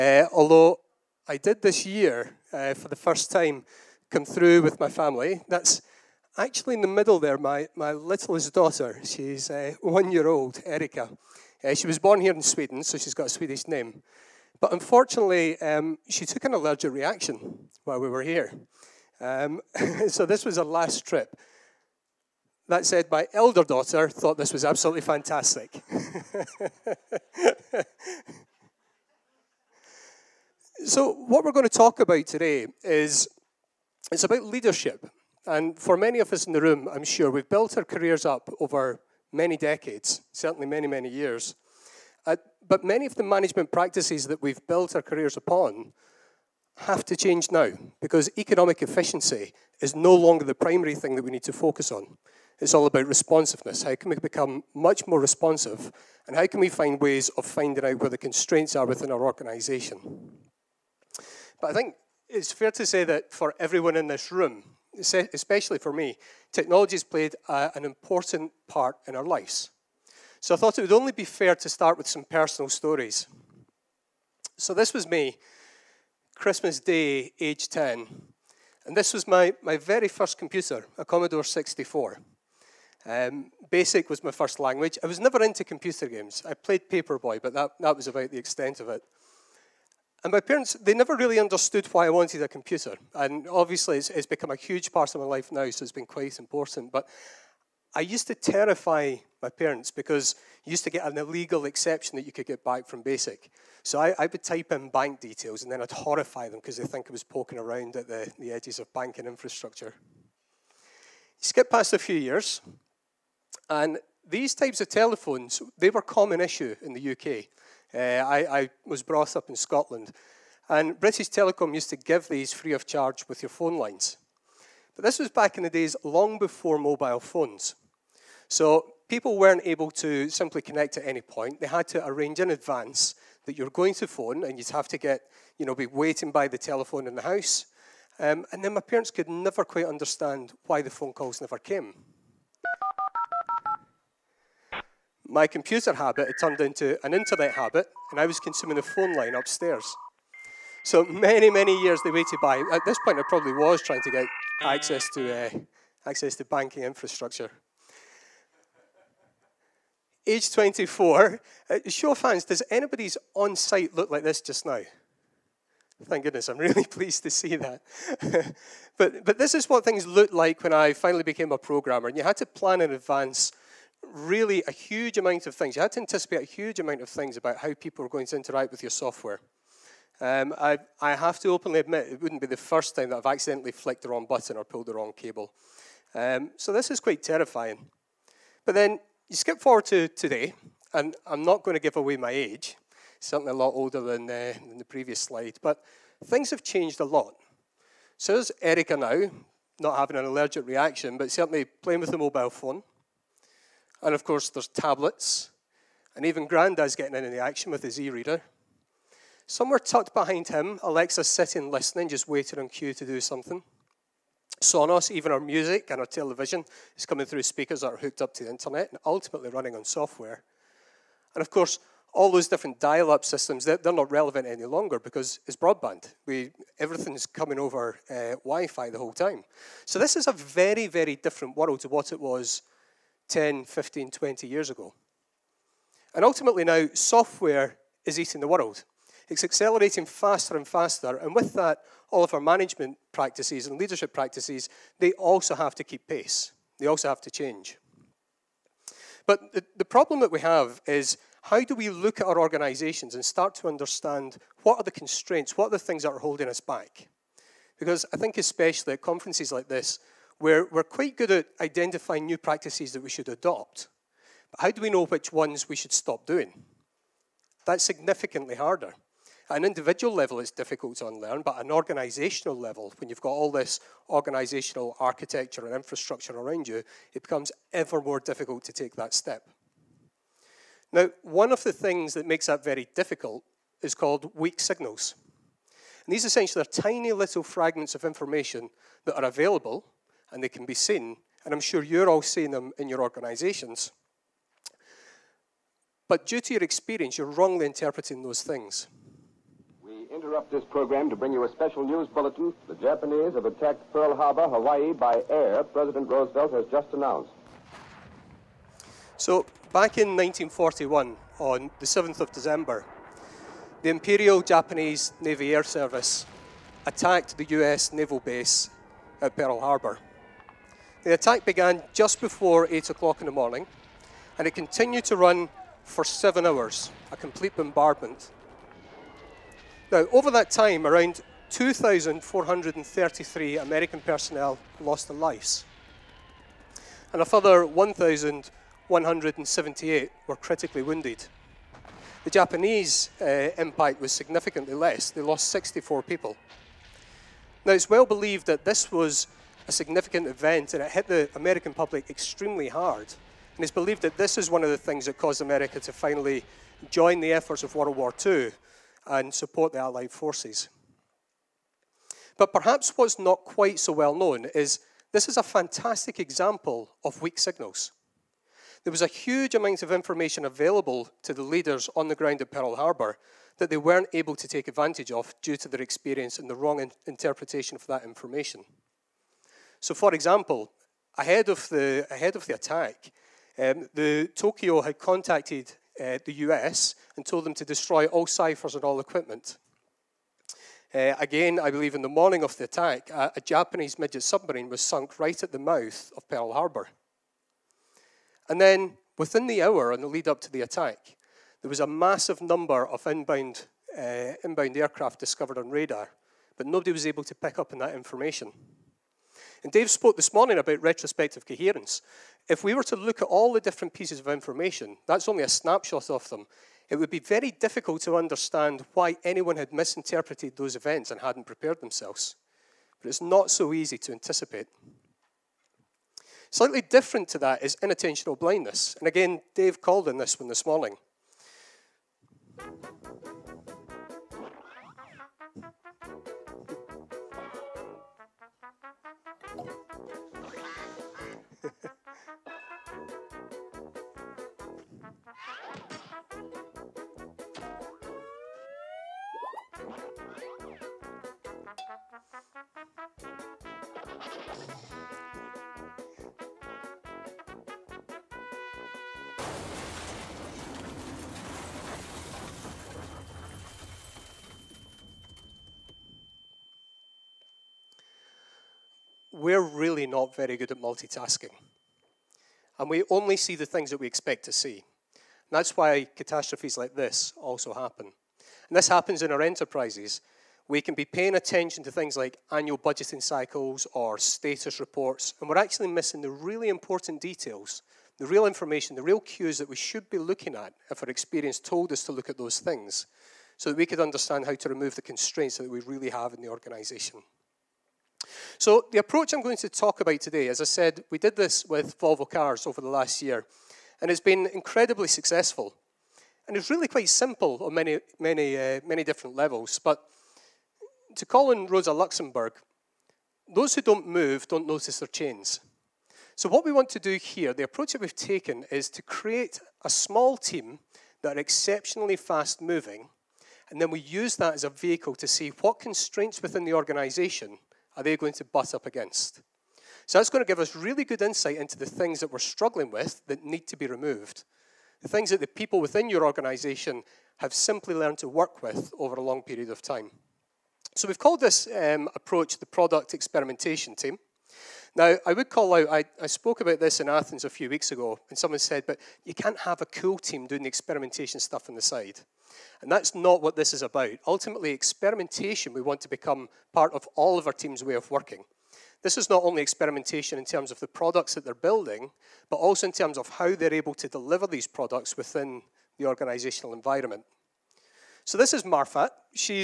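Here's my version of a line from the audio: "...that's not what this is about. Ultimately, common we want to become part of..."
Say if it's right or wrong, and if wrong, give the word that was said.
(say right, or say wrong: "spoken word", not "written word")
wrong: "experimentation", not "common".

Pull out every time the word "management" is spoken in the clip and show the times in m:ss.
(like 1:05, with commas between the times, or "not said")
0:43, 4:02.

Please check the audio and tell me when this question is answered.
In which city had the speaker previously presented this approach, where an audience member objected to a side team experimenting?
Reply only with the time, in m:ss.
9:07.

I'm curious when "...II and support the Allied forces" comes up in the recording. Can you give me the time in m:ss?
5:58.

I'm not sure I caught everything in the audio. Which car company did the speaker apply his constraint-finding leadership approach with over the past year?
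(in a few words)
Volvo Cars.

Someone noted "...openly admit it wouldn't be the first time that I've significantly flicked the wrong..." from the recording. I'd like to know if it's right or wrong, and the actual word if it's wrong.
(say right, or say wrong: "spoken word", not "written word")
wrong: "accidentally", not "significantly".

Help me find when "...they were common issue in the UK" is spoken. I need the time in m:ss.
1:55.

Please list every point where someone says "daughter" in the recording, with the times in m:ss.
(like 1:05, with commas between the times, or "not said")
0:08, 0:23.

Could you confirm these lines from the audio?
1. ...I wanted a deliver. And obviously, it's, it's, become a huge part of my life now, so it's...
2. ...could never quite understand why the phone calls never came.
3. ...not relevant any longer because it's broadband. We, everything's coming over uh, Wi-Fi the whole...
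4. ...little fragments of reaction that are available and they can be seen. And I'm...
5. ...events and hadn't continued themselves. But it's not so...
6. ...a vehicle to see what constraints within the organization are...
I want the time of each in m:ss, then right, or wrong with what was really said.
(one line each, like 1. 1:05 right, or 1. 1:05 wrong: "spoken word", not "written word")
1. 1:32 wrong: "computer", not "deliver"
2. 2:19 right
3. 3:43 right
4. 4:47 wrong: "information", not "reaction"
5. 7:00 wrong: "prepared", not "continued"
6. 8:44 right.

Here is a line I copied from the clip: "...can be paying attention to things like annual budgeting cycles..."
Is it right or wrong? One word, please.
right.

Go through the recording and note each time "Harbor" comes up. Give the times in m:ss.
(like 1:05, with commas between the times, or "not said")
5:04, 5:19, 6:12, 6:36.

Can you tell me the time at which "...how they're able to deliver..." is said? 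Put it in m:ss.
9:23.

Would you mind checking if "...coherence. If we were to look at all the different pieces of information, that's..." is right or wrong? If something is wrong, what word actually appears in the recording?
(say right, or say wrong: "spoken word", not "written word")
right.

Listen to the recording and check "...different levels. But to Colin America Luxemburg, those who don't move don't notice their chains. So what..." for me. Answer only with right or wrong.
wrong.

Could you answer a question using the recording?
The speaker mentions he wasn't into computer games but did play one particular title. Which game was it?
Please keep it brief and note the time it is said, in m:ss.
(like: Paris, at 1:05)
Paperboy, at 1:26.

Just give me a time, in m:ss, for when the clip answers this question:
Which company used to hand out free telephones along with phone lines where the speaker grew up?
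2:00.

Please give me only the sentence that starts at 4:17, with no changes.
Because I think, especially at conferences like this, we're, we're quite good at identifying new practices that we should adopt.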